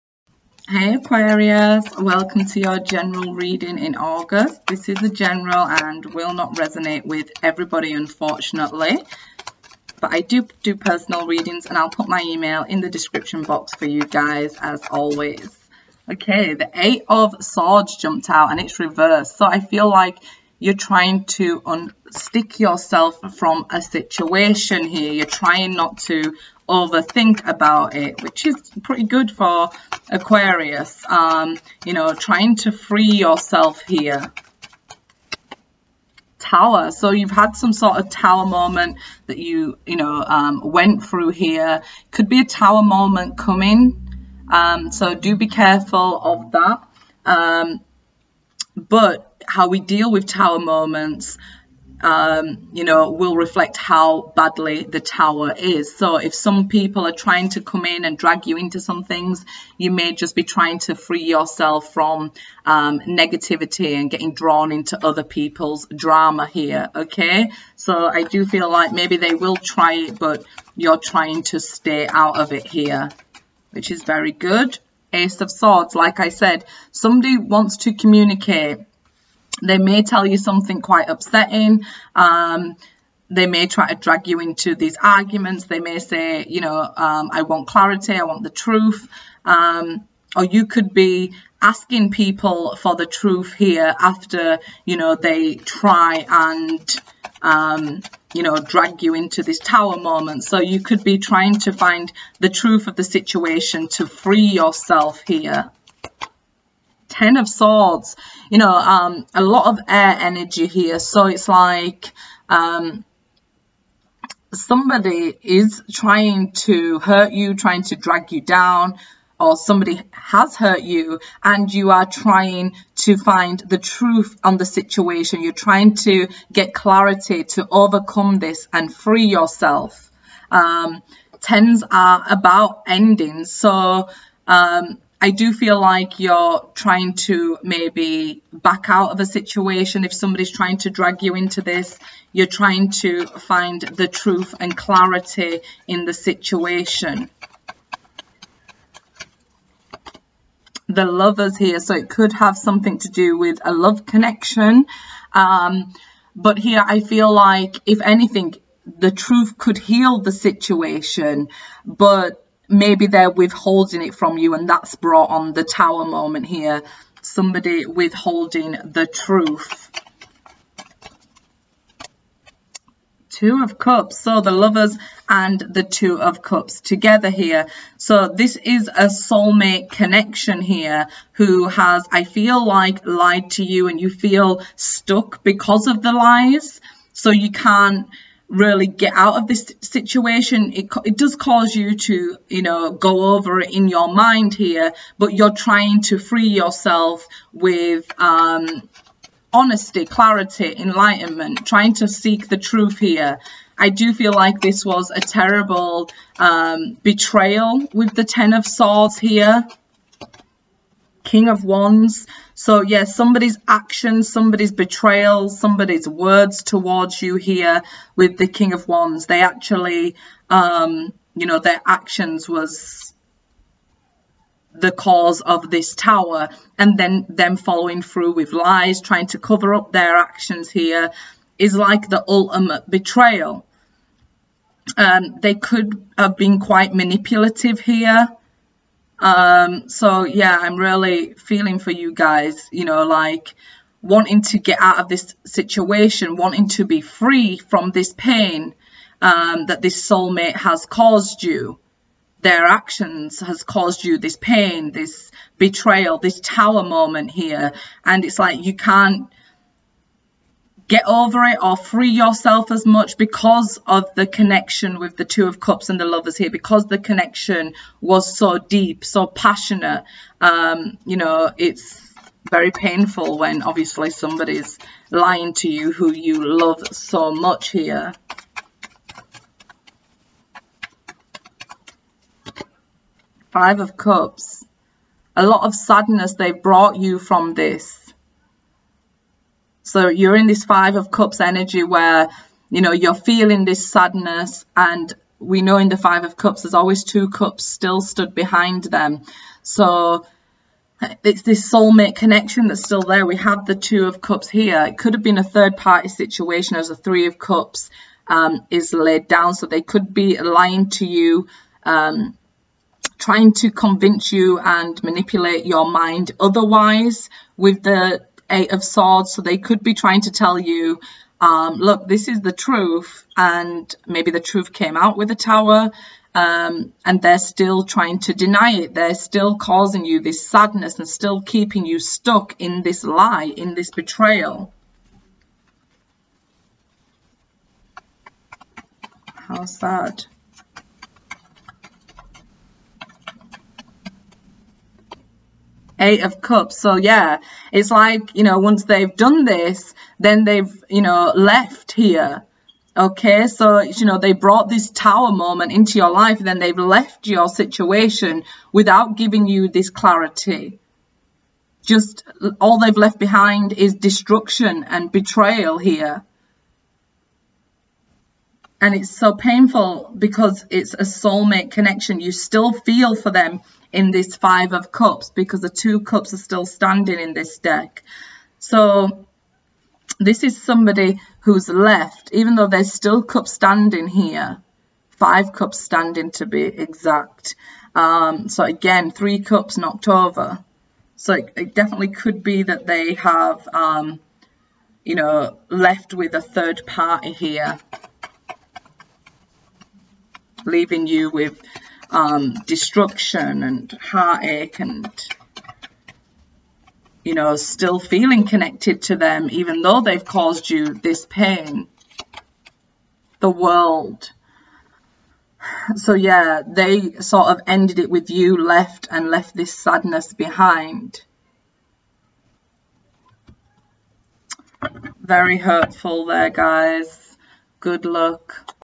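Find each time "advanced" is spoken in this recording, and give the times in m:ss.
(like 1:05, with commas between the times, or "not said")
not said.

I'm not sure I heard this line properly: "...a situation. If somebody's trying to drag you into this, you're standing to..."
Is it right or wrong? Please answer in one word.
wrong.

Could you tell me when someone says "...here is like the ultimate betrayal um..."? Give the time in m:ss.
3:50.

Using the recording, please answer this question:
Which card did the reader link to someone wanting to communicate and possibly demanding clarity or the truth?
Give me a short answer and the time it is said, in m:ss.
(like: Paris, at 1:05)
Ace of Swords, at 1:15.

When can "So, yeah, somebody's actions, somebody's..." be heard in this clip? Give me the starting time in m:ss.
3:32.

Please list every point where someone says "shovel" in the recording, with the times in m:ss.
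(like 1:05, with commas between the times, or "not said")
not said.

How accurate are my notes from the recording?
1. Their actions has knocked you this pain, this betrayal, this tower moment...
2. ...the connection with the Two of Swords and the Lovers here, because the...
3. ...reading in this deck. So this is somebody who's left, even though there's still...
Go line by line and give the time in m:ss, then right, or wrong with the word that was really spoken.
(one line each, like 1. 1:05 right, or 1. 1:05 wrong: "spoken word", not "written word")
1. 4:12 wrong: "caused", not "knocked"
2. 4:24 wrong: "Cups", not "Swords"
3. 6:16 wrong: "standing", not "reading".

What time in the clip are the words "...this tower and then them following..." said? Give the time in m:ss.
3:45.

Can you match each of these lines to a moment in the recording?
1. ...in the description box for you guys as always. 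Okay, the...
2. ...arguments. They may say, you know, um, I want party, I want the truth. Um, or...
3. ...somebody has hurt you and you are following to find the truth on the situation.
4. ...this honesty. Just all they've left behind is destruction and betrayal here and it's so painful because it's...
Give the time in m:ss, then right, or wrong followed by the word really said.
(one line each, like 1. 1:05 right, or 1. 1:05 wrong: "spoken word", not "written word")
1. 0:12 right
2. 1:25 wrong: "clarity", not "party"
3. 1:59 wrong: "trying", not "following"
4. 5:59 wrong: "clarity", not "honesty".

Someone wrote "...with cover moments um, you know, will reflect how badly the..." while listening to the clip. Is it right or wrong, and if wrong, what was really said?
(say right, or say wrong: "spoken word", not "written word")
wrong: "tower", not "cover".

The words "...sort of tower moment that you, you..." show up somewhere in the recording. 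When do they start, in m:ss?
0:37.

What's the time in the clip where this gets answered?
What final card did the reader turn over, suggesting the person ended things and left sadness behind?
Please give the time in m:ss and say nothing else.
6:53.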